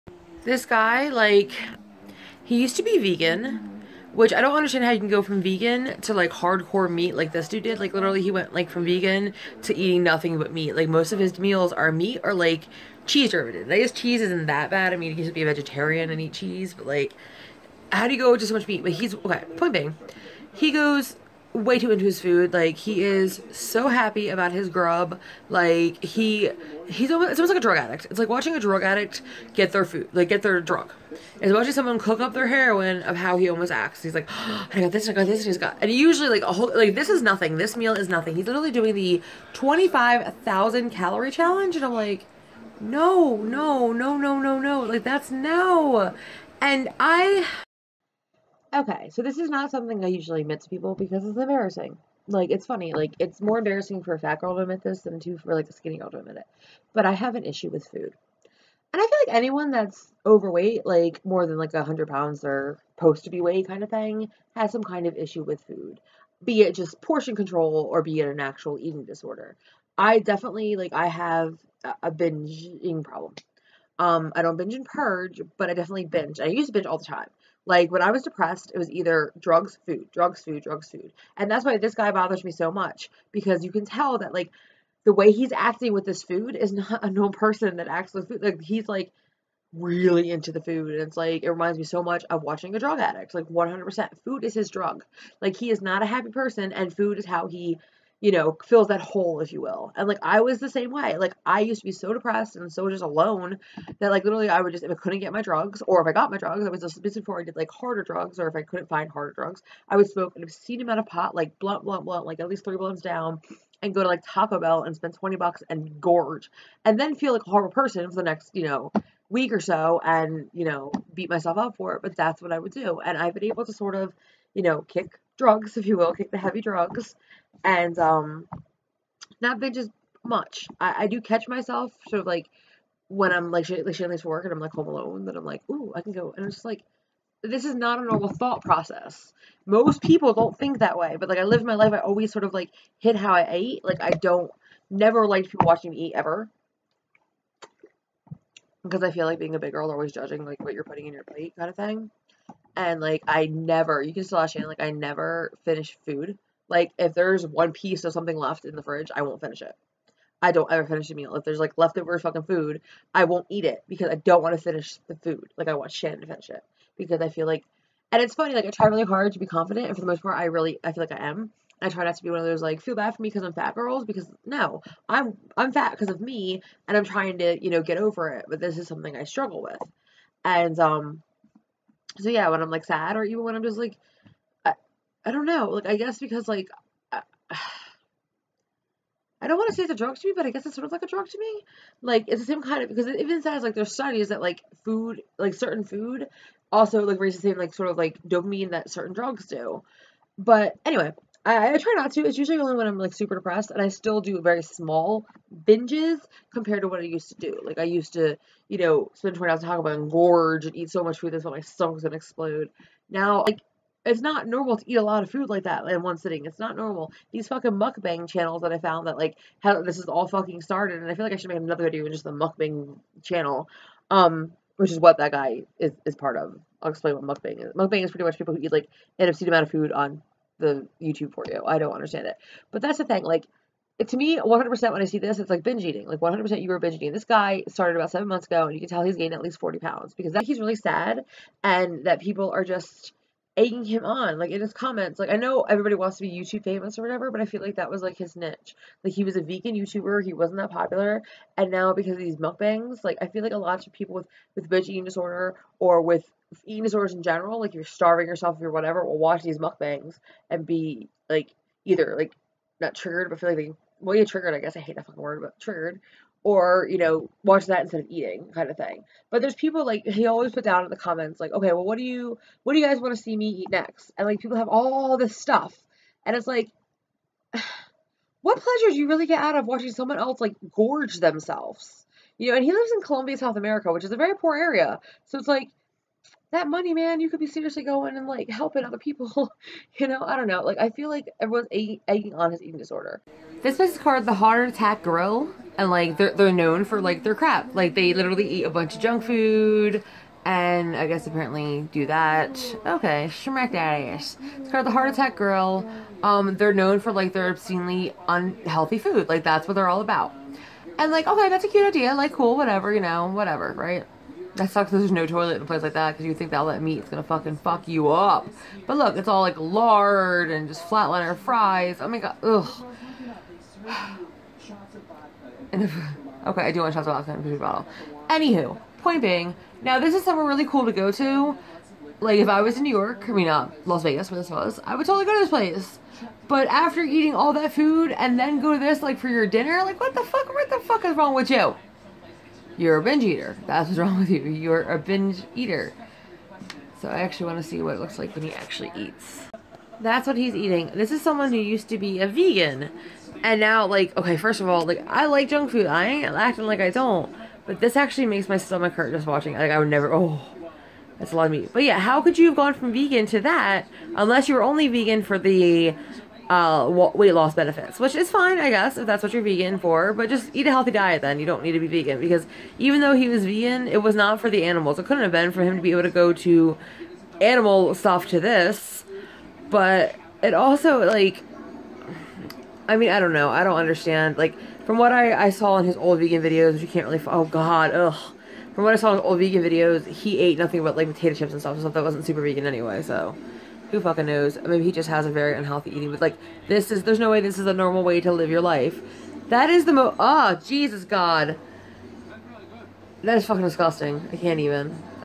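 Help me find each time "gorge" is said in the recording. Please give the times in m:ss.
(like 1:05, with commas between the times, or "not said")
1:55, 3:30, 4:40.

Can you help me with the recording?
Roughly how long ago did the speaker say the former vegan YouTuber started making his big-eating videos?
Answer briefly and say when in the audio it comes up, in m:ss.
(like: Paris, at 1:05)
7 months, at 3:58.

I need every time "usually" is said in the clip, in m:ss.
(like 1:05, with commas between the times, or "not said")
0:35, 0:50, 3:22.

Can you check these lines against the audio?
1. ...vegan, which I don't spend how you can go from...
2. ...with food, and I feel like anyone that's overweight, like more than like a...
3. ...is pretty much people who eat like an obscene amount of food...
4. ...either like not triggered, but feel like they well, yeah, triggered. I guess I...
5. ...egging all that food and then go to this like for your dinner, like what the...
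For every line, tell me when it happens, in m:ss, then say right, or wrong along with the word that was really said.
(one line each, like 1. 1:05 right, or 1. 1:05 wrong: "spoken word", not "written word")
1. 0:02 wrong: "understand", not "spend"
2. 0:57 right
3. 3:48 right
4. 4:21 right
5. 5:37 wrong: "eating", not "egging".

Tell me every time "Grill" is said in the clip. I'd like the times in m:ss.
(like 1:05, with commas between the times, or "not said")
4:55, 5:05.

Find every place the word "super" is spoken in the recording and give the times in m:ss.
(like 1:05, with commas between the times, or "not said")
3:23, 6:32.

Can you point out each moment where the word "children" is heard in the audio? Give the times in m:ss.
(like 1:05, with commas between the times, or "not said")
not said.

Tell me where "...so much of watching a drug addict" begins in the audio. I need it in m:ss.
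1:31.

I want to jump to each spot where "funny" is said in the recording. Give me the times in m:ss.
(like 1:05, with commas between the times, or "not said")
0:52, 2:48.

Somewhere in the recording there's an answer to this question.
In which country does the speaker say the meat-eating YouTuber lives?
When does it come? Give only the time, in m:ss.
4:43.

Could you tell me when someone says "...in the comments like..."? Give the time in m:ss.
4:30.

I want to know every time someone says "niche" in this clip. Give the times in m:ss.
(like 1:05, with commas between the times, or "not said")
4:08.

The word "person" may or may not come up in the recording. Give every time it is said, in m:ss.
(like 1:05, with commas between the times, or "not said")
1:27, 1:36, 1:57.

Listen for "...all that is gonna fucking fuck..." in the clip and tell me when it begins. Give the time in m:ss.
5:16.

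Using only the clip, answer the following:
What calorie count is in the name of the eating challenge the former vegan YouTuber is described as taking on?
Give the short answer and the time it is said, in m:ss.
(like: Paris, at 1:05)
25,000, at 0:39.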